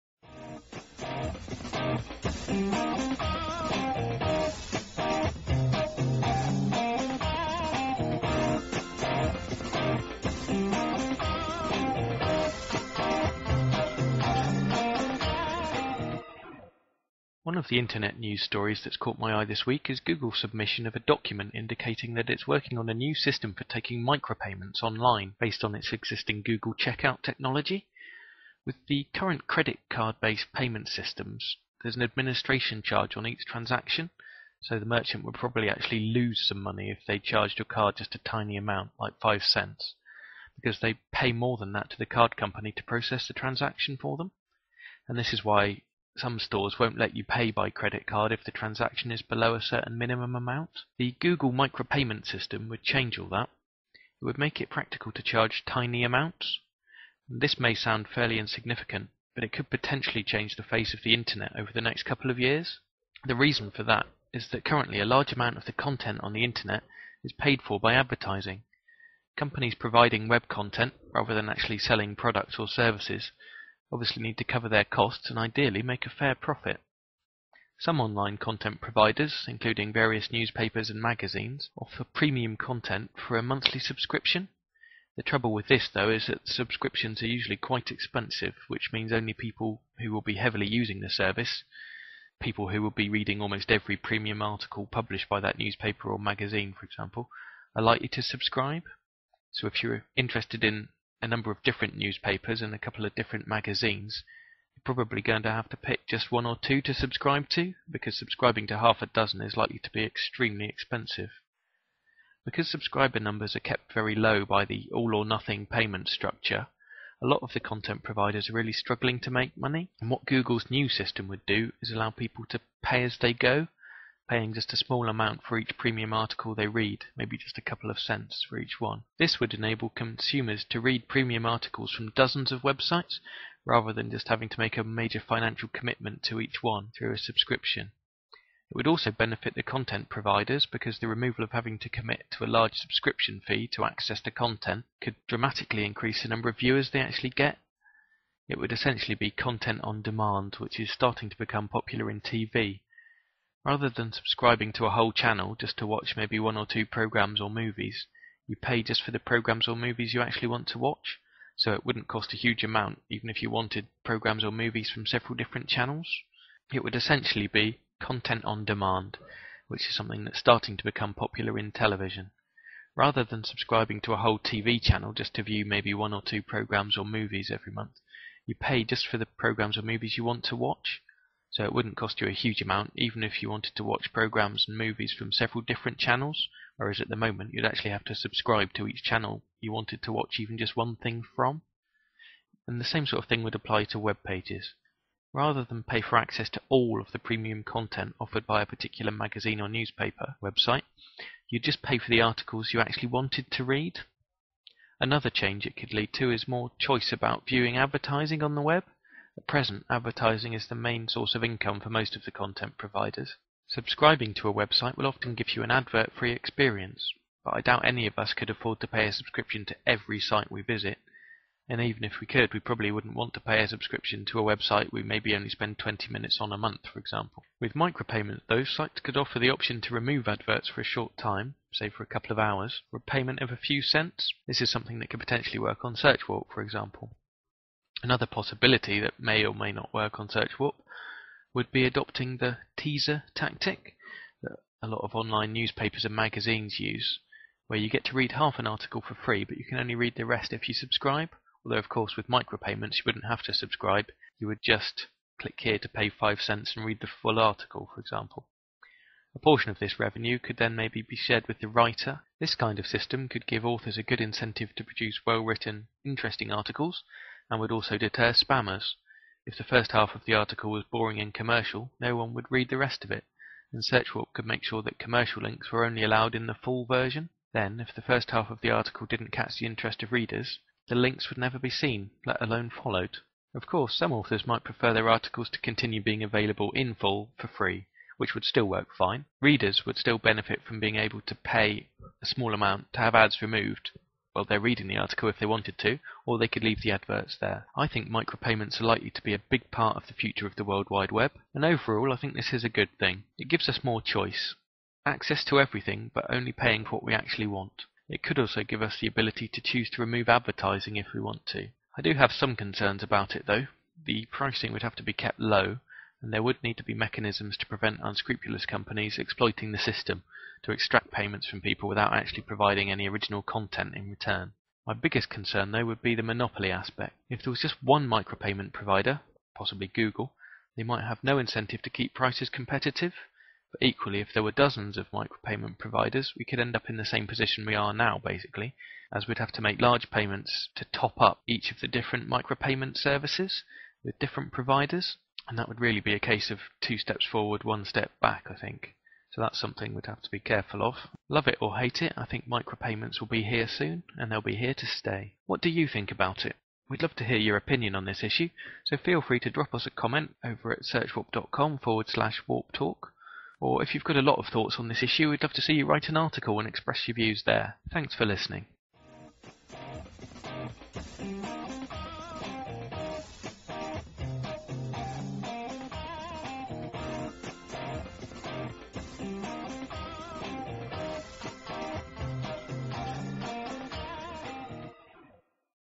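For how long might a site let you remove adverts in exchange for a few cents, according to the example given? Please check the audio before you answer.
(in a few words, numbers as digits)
a couple of hours.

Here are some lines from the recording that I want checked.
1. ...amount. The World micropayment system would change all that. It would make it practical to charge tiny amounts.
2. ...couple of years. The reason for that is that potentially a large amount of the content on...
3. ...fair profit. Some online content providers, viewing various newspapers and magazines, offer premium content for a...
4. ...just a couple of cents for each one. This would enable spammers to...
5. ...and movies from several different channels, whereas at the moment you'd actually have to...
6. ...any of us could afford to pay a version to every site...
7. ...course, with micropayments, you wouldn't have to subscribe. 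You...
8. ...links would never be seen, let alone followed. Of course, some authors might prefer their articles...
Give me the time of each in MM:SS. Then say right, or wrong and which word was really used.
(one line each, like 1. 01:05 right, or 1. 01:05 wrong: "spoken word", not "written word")
1. 00:50 wrong: "Google", not "World"
2. 01:02 wrong: "currently", not "potentially"
3. 01:16 wrong: "including", not "viewing"
4. 02:07 wrong: "consumers", not "spammers"
5. 03:04 right
6. 03:37 wrong: "subscription", not "version"
7. 04:11 right
8. 04:40 right.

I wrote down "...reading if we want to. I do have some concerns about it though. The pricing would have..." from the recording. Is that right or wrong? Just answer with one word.
wrong.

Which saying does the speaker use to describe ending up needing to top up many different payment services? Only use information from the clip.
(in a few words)
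two steps forward, one step back.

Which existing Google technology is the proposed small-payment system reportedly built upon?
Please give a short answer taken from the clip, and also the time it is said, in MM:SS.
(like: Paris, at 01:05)
Google Checkout, at 00:26.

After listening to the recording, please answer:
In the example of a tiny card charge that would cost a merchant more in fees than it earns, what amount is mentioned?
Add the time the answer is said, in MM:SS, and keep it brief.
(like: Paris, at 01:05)
5 cents, at 00:39.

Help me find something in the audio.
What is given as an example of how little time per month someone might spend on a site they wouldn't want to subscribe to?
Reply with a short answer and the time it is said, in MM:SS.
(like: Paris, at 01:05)
20 minutes, at 03:45.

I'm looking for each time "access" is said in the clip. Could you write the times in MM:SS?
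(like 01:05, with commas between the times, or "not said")
02:23, 03:16, 05:05.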